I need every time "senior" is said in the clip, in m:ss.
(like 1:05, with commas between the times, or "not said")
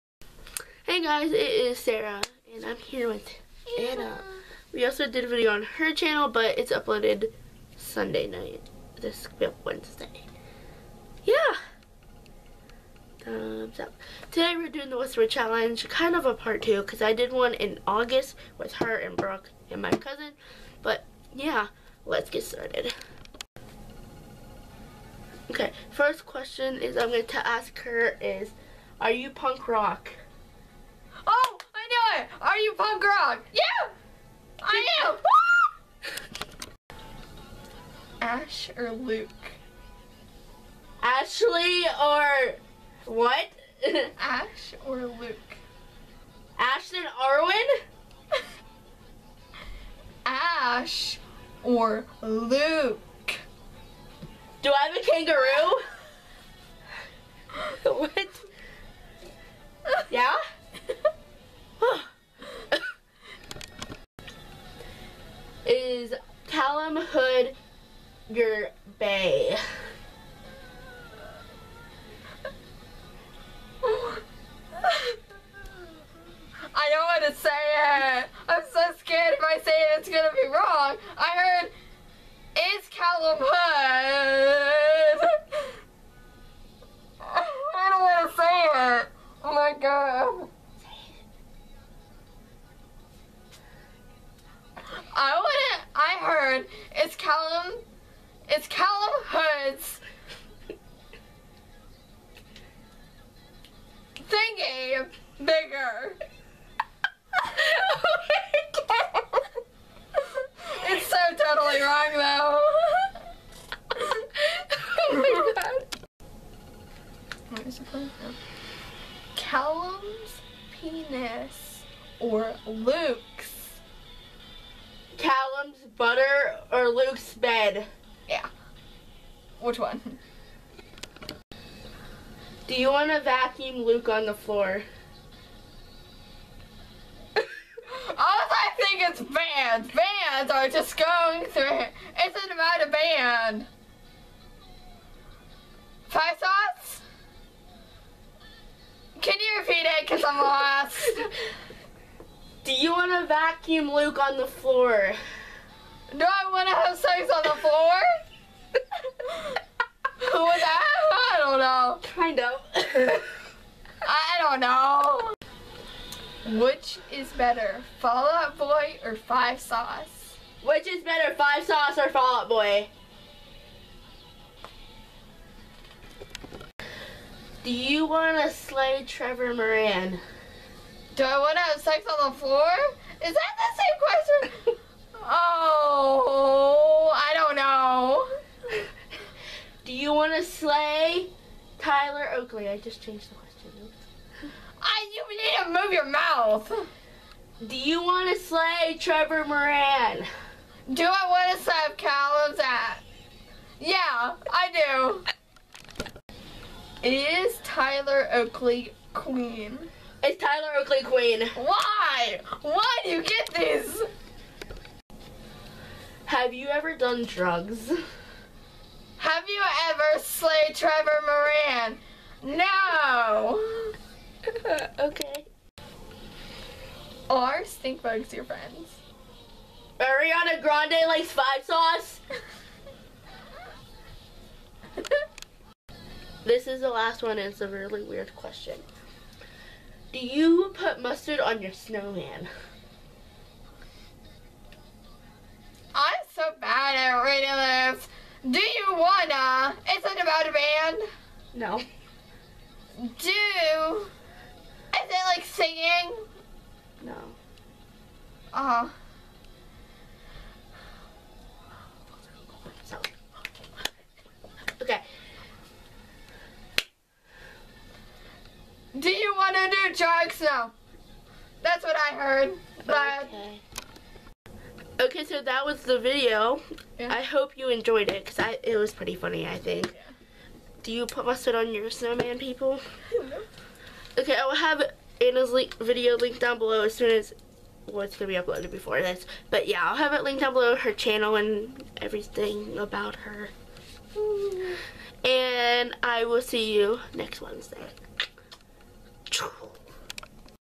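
not said.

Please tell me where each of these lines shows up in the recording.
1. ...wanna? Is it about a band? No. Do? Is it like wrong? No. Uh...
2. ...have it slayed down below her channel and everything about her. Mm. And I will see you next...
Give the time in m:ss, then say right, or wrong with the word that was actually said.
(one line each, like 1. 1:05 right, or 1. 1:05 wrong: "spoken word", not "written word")
1. 4:08 wrong: "singing", not "wrong"
2. 4:49 wrong: "linked", not "slayed".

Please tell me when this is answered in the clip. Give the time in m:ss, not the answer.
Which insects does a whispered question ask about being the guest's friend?
3:47.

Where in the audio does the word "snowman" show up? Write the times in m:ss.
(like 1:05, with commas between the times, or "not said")
4:01, 4:41.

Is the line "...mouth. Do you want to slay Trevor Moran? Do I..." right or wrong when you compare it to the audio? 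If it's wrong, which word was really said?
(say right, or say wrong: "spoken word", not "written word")
right.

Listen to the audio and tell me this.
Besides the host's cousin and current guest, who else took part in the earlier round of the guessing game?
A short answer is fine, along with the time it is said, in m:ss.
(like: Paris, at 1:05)
Brooke, at 0:19.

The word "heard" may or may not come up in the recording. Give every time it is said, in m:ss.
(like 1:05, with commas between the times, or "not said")
1:21, 4:32.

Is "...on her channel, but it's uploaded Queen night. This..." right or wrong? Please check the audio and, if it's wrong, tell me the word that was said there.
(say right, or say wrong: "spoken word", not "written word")
wrong: "Sunday", not "Queen".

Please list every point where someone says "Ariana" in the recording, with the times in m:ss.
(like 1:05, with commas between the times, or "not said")
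3:49.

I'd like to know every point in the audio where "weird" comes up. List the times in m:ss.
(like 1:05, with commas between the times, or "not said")
3:58.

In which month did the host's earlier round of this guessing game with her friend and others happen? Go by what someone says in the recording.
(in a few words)
August.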